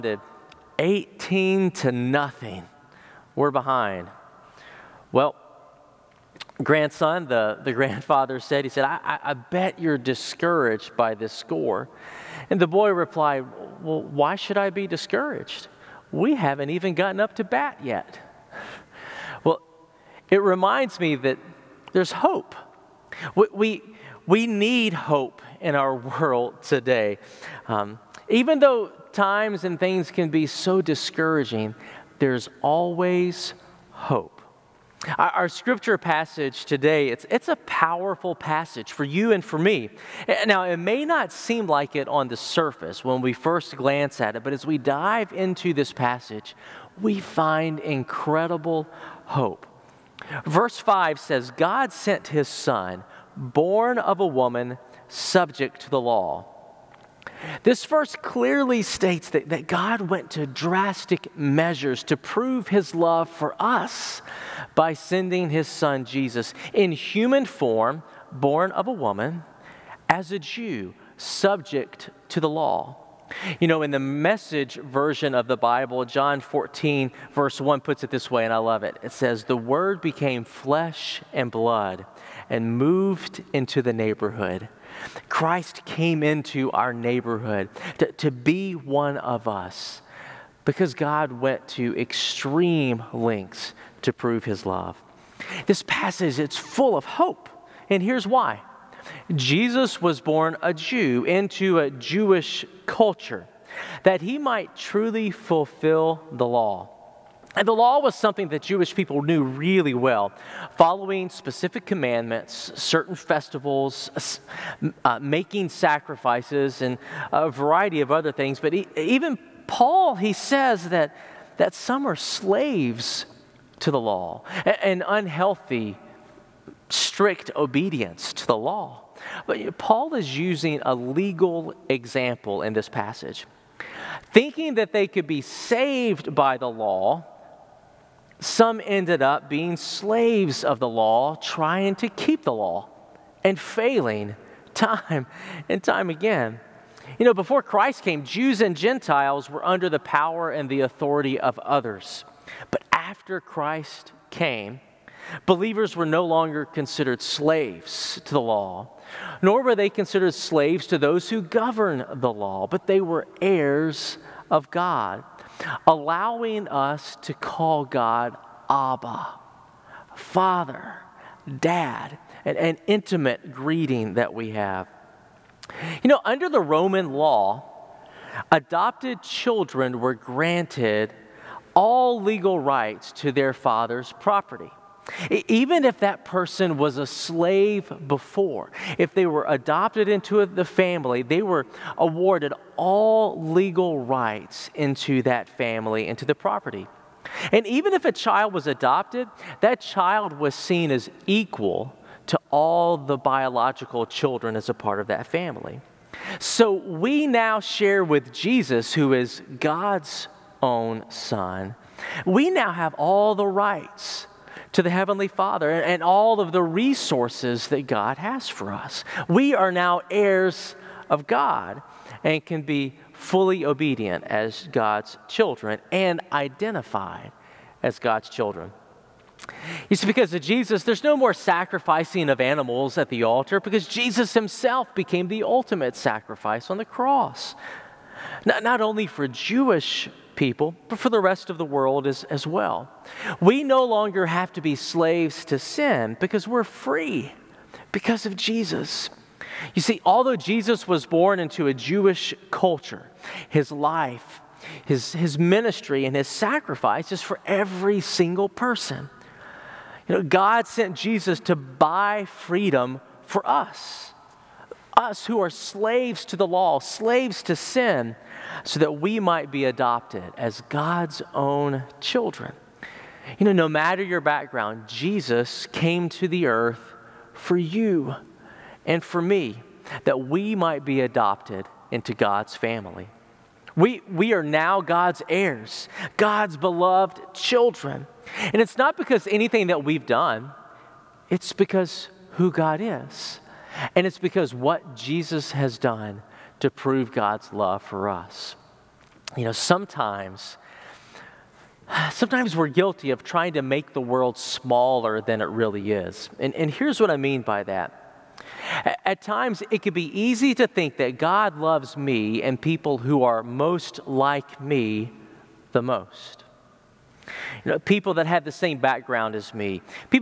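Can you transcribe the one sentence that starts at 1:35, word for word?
This passage it's full of hope, and here's why.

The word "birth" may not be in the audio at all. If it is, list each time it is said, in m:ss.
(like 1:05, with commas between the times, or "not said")
not said.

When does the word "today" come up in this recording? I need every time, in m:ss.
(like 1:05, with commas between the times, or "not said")
0:26, 0:36.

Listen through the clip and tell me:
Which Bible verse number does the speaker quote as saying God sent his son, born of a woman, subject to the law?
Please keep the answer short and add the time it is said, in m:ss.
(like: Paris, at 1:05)
Verse 5, at 0:50.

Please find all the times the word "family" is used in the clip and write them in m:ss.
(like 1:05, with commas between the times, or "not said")
3:10, 3:15, 3:25, 4:42.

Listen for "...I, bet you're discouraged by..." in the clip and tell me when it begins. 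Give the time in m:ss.
0:09.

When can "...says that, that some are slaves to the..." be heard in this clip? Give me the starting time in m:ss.
2:00.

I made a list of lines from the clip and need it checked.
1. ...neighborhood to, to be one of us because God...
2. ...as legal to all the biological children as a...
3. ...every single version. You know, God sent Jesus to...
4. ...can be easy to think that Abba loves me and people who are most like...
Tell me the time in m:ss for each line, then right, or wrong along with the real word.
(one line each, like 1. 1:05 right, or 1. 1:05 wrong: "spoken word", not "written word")
1. 1:26 right
2. 3:20 wrong: "equal", not "legal"
3. 4:17 wrong: "person", not "version"
4. 5:09 wrong: "God", not "Abba".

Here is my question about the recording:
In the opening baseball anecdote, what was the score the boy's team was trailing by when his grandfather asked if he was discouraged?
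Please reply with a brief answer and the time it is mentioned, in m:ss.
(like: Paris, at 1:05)
18 to 0, at 0:00.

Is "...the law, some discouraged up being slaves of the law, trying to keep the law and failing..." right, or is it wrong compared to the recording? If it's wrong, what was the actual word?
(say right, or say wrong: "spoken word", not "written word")
wrong: "ended", not "discouraged".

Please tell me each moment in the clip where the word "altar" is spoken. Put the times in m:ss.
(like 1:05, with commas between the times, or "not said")
3:53.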